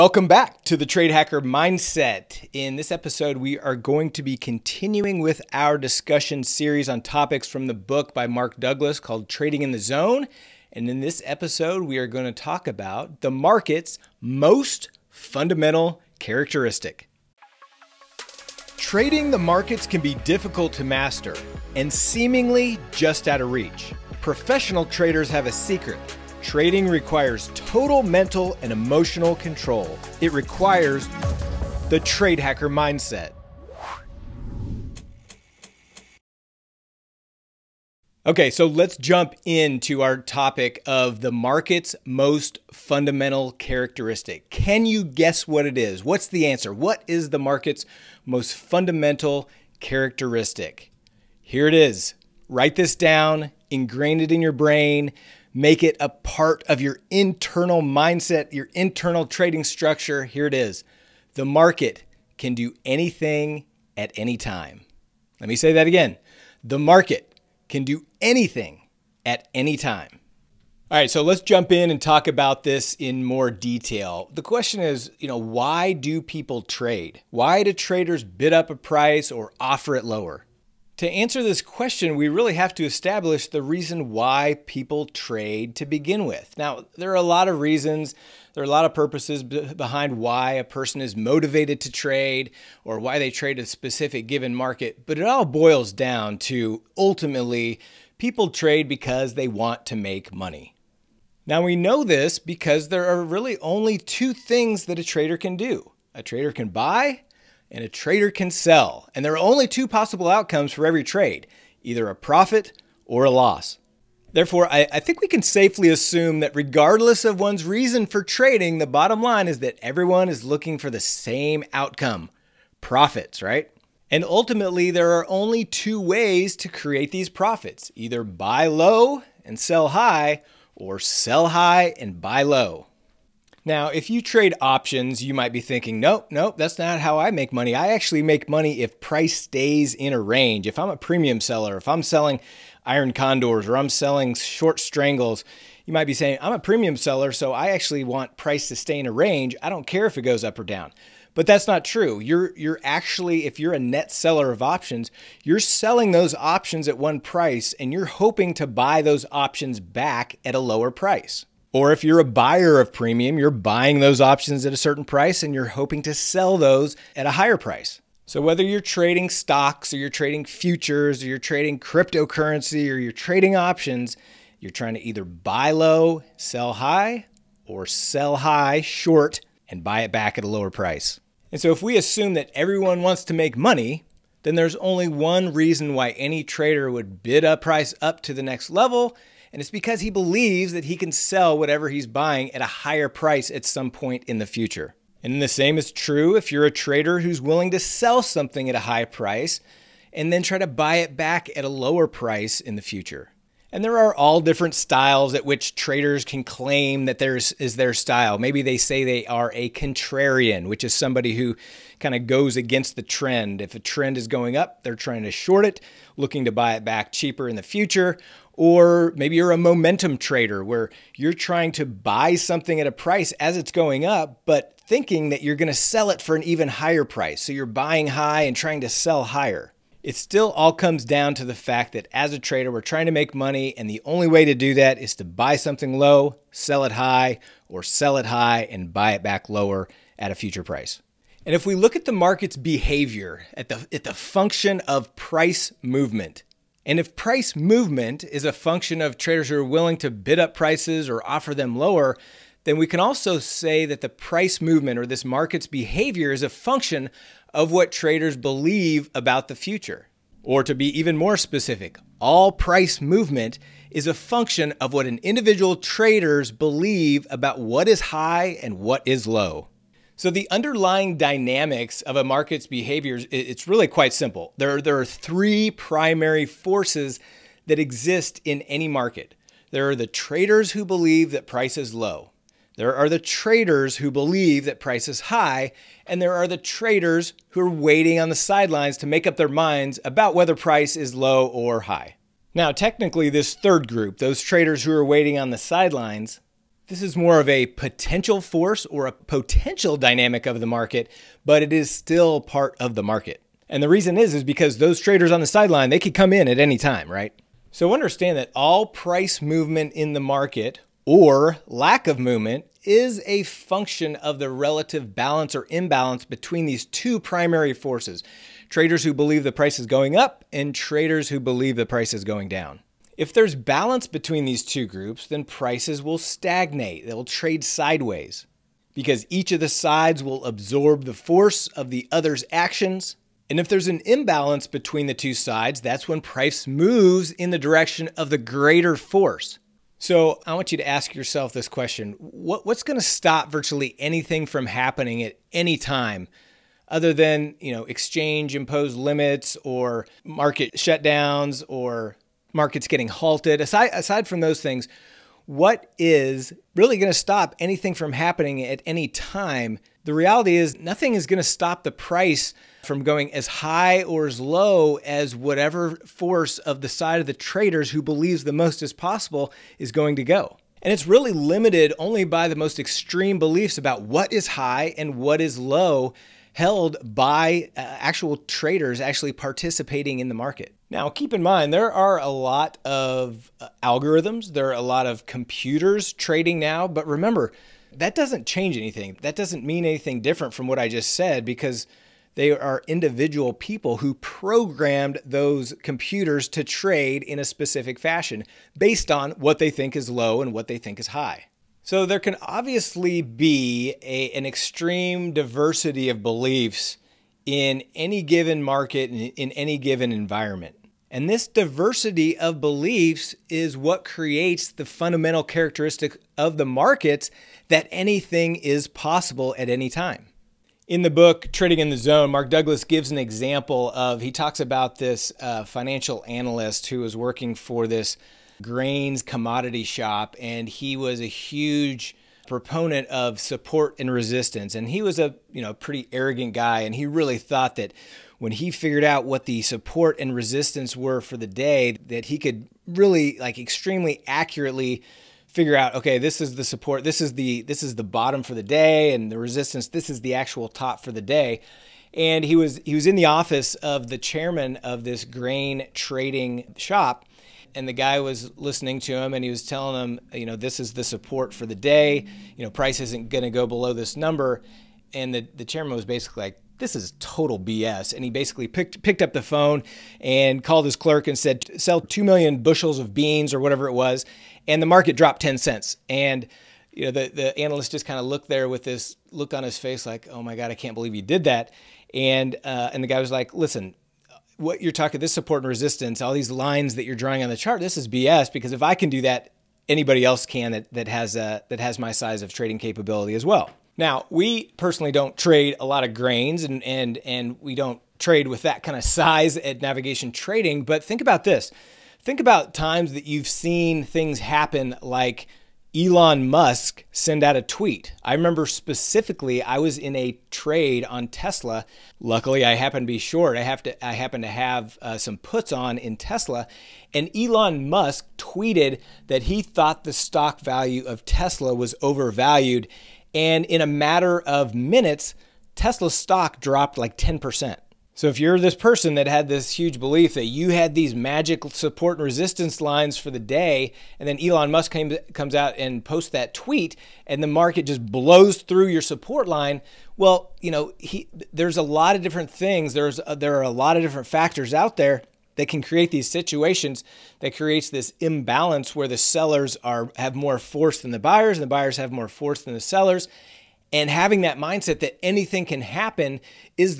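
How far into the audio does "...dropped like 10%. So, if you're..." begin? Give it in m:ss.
8:46.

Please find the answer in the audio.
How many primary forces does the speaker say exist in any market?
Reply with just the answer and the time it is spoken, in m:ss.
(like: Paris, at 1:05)
3, at 4:35.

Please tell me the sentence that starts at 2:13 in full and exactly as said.
Now, if you trade options, you might be thinking, nope, nope, that's not how I make money.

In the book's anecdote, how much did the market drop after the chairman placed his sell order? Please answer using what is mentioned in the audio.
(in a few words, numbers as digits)
10 cents.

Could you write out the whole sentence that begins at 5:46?
Other than you know, exchange imposed limits or market shutdowns or markets getting halted.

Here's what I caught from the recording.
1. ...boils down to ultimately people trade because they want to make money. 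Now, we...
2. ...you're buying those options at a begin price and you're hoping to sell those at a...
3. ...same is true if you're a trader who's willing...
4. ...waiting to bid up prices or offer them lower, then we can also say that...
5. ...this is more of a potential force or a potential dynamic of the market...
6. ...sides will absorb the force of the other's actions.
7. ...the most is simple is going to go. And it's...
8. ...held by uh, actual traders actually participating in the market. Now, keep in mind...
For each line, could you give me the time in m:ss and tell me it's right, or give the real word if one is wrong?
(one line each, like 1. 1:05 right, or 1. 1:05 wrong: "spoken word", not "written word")
1. 1:35 right
2. 2:43 wrong: "certain", not "begin"
3. 3:15 right
4. 4:09 wrong: "willing", not "waiting"
5. 4:56 right
6. 5:29 right
7. 6:08 wrong: "possible", not "simple"
8. 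6:16 right.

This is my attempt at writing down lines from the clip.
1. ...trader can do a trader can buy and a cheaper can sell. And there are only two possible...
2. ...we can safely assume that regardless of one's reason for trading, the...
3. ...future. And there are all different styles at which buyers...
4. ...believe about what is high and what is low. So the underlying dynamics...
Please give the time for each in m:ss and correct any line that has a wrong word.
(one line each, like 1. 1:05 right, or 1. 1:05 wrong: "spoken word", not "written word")
1. 1:45 wrong: "trader", not "cheaper"
2. 1:55 right
3. 3:22 wrong: "traders", not "buyers"
4. 4:26 right.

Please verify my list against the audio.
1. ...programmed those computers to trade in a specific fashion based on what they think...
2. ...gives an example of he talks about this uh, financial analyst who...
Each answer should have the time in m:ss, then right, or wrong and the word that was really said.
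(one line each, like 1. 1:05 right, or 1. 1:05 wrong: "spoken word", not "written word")
1. 6:34 right
2. 7:02 right.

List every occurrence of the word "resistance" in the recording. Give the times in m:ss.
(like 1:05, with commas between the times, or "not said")
7:14, 7:20, 7:29, 8:05, 8:52.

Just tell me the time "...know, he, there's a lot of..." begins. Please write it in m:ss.
9:00.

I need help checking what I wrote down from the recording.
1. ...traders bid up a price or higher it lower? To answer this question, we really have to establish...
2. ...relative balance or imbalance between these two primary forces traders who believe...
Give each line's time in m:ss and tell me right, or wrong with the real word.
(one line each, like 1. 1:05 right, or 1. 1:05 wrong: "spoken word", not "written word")
1. 1:17 wrong: "offer", not "higher"
2. 5:14 right.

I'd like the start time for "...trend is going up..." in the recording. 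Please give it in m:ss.
3:33.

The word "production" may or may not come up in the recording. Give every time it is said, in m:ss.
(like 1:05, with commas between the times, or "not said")
not said.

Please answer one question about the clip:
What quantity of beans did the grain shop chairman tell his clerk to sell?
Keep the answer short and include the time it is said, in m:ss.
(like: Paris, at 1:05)
2 million bushels, at 7:52.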